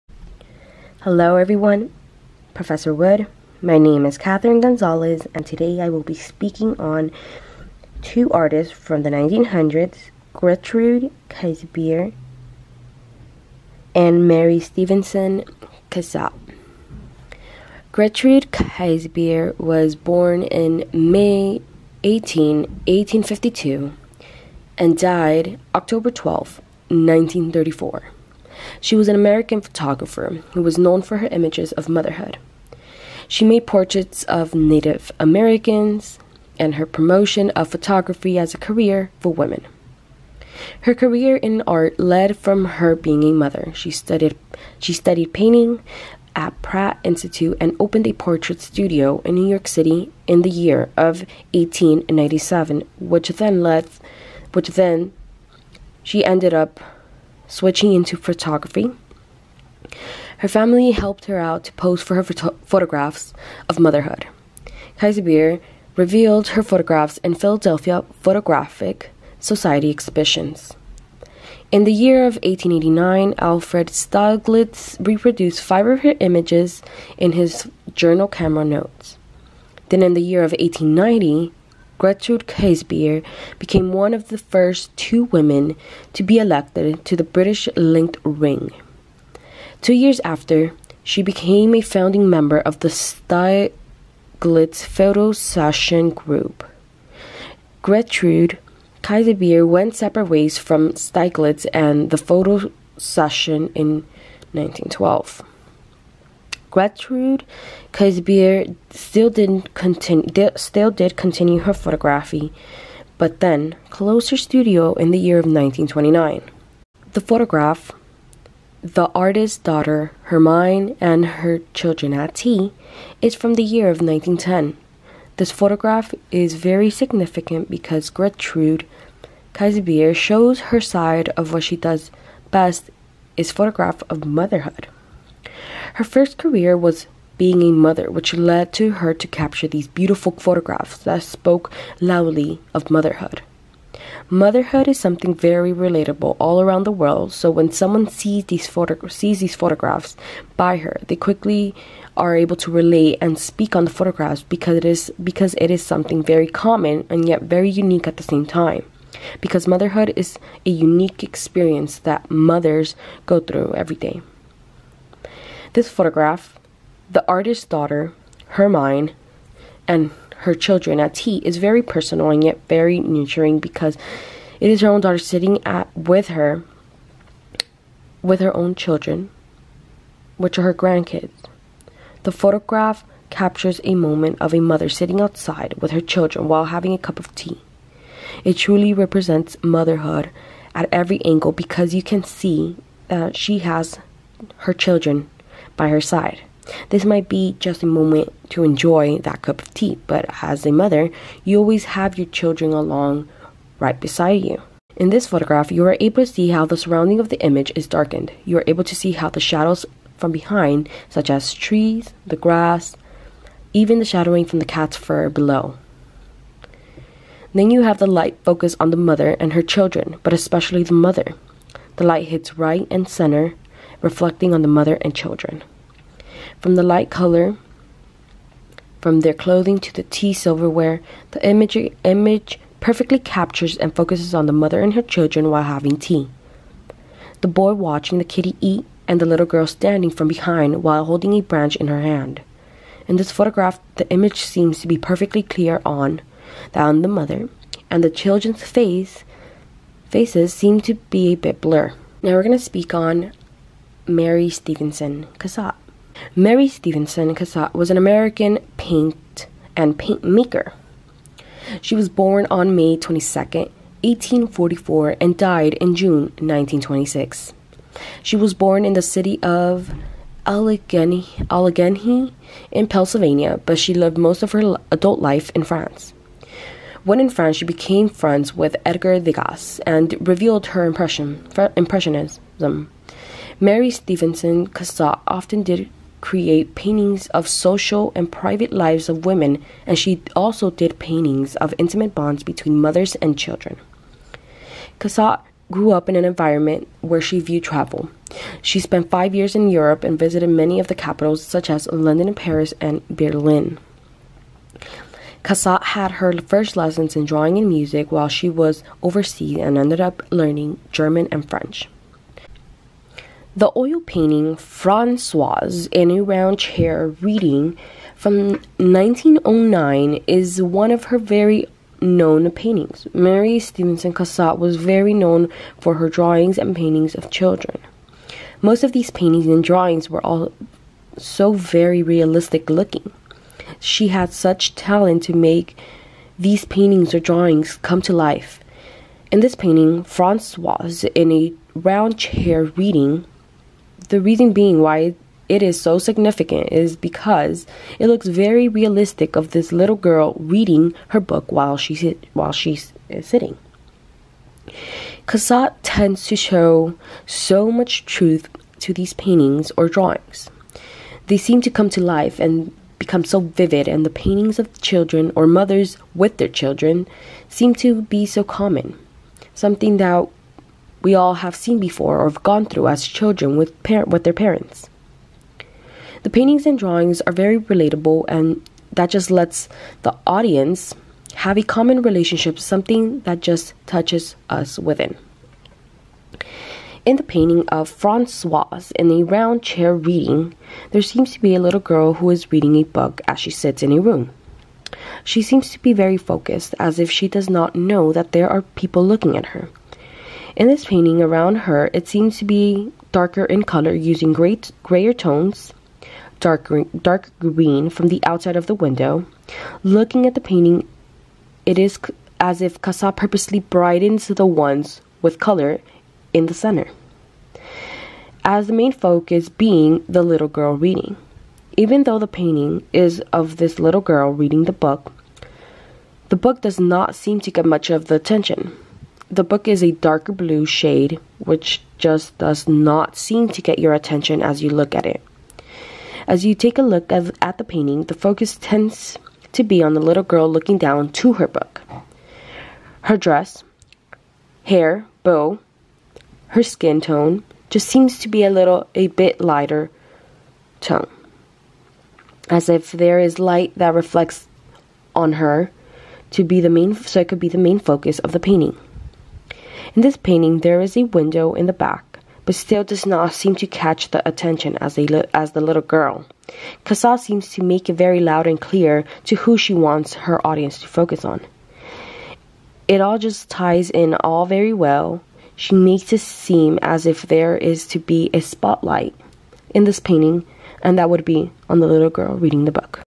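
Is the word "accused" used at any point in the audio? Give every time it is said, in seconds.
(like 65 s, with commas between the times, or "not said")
not said.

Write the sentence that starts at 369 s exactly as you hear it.
Something that we all have seen before or have gone through as children with, par- with their parents.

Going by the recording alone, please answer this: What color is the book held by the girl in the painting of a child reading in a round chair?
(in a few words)
darker blue.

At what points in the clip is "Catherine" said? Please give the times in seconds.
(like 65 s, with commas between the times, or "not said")
4 s.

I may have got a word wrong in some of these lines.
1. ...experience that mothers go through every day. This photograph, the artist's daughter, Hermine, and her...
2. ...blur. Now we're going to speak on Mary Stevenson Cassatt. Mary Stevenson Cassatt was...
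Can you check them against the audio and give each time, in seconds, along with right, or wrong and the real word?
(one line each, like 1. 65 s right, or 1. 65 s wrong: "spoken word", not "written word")
1. 161 s right
2. 251 s right.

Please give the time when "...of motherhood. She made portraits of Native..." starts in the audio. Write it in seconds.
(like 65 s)
31 s.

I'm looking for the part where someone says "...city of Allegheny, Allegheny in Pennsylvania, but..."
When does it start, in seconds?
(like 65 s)
269 s.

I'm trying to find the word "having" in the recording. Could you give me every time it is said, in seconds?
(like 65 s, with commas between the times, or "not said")
186 s, 235 s.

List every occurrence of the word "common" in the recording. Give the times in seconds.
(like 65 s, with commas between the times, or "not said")
156 s, 368 s, 381 s.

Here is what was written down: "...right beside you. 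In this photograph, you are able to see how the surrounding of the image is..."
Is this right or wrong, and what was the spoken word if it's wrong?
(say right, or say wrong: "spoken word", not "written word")
right.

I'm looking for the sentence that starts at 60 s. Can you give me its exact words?
Her family helped her out to pose for her photographs of motherhood.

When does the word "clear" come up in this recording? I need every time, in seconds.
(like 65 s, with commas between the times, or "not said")
245 s, 468 s.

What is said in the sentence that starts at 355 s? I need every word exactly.
Cassatt tends to show so much truth to these paintings or drawings.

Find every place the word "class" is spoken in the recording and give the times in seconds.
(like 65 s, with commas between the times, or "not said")
not said.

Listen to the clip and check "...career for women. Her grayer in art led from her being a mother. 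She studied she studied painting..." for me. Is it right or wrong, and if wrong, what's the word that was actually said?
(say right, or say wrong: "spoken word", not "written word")
wrong: "career", not "grayer".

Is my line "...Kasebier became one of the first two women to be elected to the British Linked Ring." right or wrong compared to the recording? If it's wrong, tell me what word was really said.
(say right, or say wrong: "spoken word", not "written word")
right.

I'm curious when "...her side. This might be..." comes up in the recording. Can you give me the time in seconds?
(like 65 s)
195 s.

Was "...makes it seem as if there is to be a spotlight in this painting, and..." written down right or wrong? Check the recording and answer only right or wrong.
right.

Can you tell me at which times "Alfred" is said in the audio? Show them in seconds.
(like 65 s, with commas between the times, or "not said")
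73 s.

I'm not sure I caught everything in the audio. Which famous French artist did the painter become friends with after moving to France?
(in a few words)
Edgar Degas.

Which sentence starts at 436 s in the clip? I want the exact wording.
As you take a look at the painting, the focus tends to be on the little girl looking down to her book.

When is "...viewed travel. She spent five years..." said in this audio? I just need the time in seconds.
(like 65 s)
297 s.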